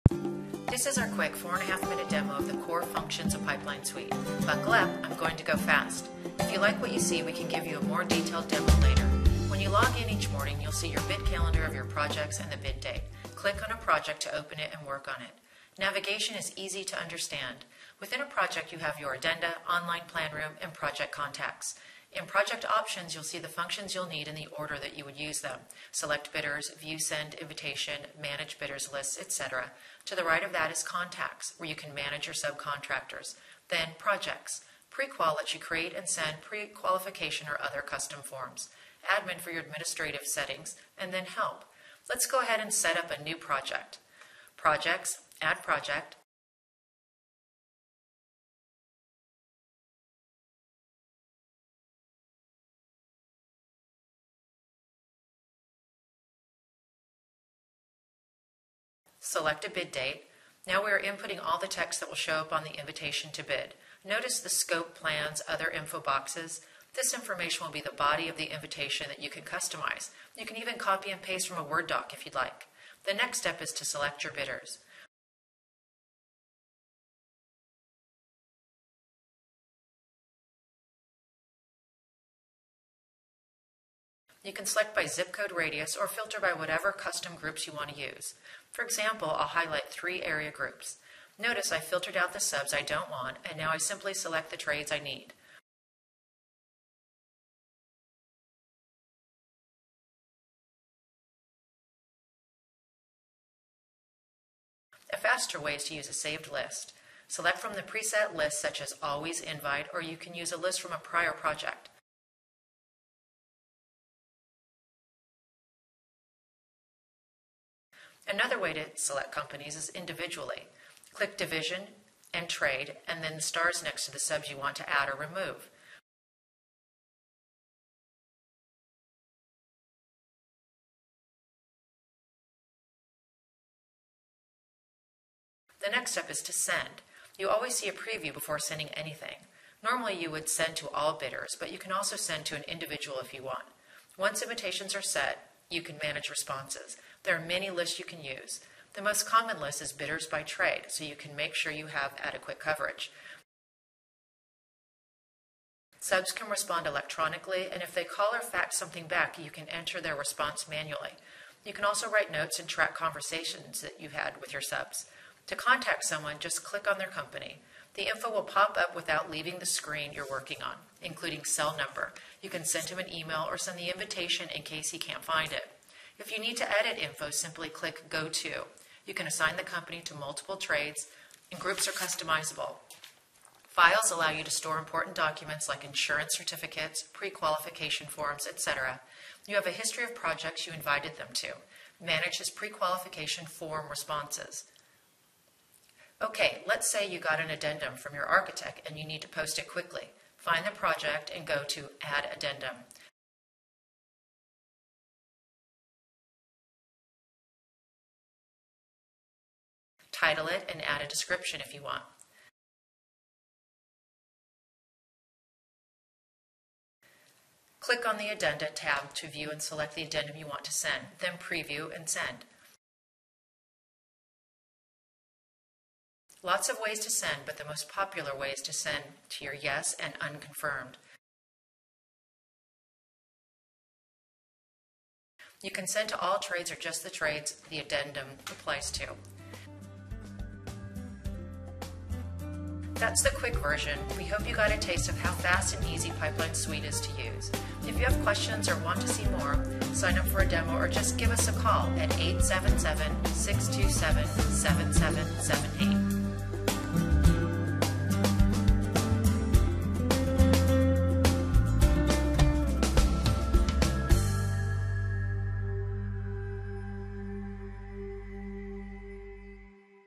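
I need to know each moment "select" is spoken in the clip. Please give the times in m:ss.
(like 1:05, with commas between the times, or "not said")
0:25, 0:59, 1:13, 1:24, 1:34, 1:47, 1:58, 3:39.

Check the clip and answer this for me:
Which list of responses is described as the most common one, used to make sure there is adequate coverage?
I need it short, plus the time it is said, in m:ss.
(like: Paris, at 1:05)
bidders by trade, at 2:29.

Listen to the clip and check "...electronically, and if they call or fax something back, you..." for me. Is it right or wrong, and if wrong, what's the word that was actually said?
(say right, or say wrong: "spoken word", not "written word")
right.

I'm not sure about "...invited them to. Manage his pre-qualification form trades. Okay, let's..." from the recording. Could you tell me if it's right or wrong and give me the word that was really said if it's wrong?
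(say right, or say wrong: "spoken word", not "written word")
wrong: "responses", not "trades".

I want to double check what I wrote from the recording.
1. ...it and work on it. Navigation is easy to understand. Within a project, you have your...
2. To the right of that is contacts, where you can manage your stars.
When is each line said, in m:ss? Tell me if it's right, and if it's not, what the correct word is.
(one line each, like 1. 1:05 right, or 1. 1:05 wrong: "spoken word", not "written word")
1. 0:14 right
2. 0:30 wrong: "subcontractors", not "stars".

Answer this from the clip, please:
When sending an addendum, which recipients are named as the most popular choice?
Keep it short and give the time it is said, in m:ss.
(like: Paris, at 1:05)
yes and unconfirmed, at 3:49.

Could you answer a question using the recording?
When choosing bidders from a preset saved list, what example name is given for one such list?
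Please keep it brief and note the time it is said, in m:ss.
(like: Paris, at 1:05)
Always Invite, at 1:49.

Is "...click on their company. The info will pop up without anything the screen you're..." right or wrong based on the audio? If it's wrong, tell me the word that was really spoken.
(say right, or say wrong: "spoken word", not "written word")
wrong: "leaving", not "anything".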